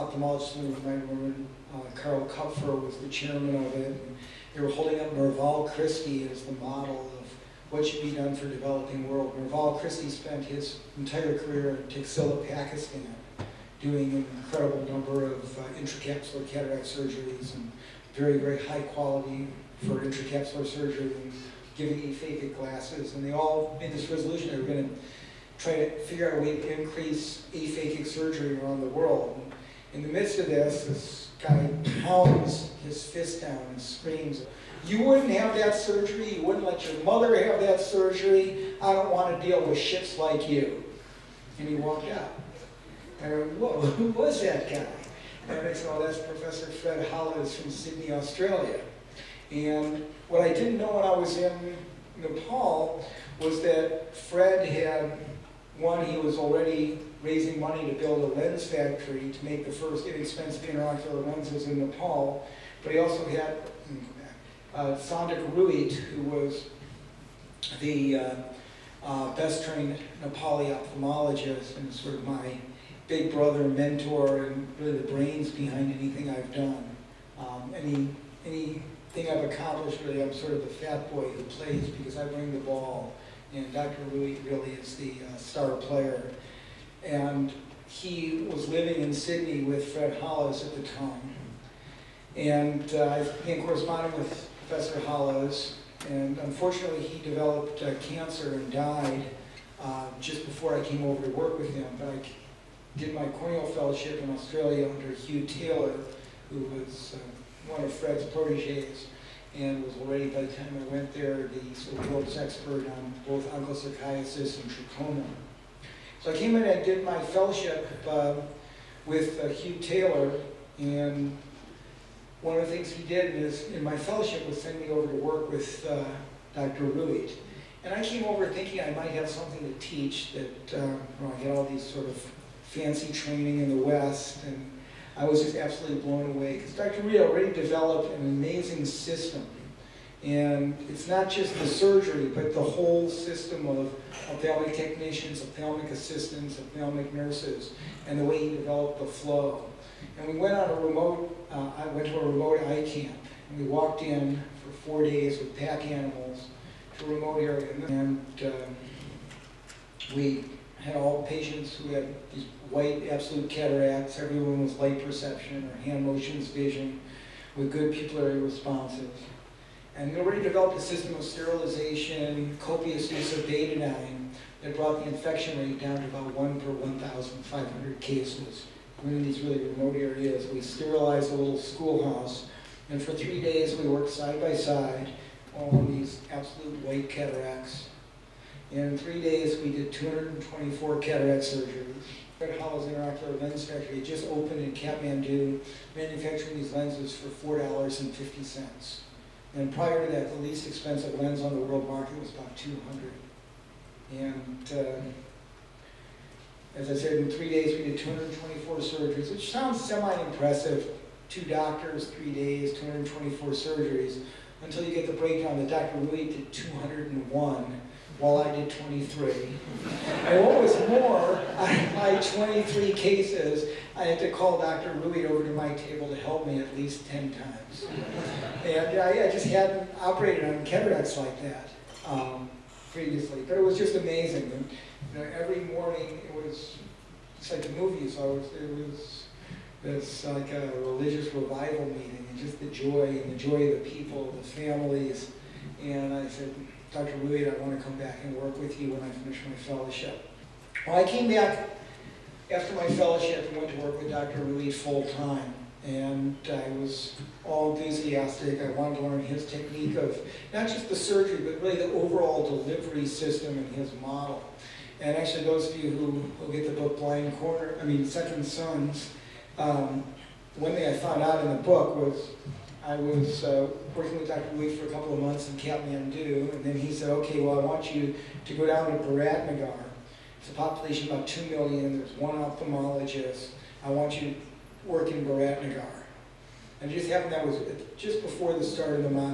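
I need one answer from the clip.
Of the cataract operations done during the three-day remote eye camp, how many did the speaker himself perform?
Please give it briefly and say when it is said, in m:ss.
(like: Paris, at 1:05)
23, at 3:38.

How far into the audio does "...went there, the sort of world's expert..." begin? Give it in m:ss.
1:50.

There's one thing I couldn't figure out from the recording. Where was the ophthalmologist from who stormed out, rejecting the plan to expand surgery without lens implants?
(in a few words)
Sydney, Australia.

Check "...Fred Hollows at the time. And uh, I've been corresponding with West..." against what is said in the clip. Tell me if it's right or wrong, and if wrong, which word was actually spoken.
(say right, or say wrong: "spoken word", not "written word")
wrong: "Professor", not "West".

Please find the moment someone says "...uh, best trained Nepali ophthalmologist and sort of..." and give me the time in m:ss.
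1:09.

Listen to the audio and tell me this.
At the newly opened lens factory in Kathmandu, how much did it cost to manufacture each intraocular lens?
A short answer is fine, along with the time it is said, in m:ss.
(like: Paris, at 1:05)
$4.50, at 3:17.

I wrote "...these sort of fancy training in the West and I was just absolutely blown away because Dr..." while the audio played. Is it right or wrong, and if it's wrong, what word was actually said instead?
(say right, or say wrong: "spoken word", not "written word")
right.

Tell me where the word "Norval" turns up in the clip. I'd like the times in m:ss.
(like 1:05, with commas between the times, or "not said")
0:05, 0:09.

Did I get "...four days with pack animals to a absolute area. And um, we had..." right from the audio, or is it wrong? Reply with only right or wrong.
wrong.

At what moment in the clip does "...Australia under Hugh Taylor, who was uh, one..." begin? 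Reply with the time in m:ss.
1:44.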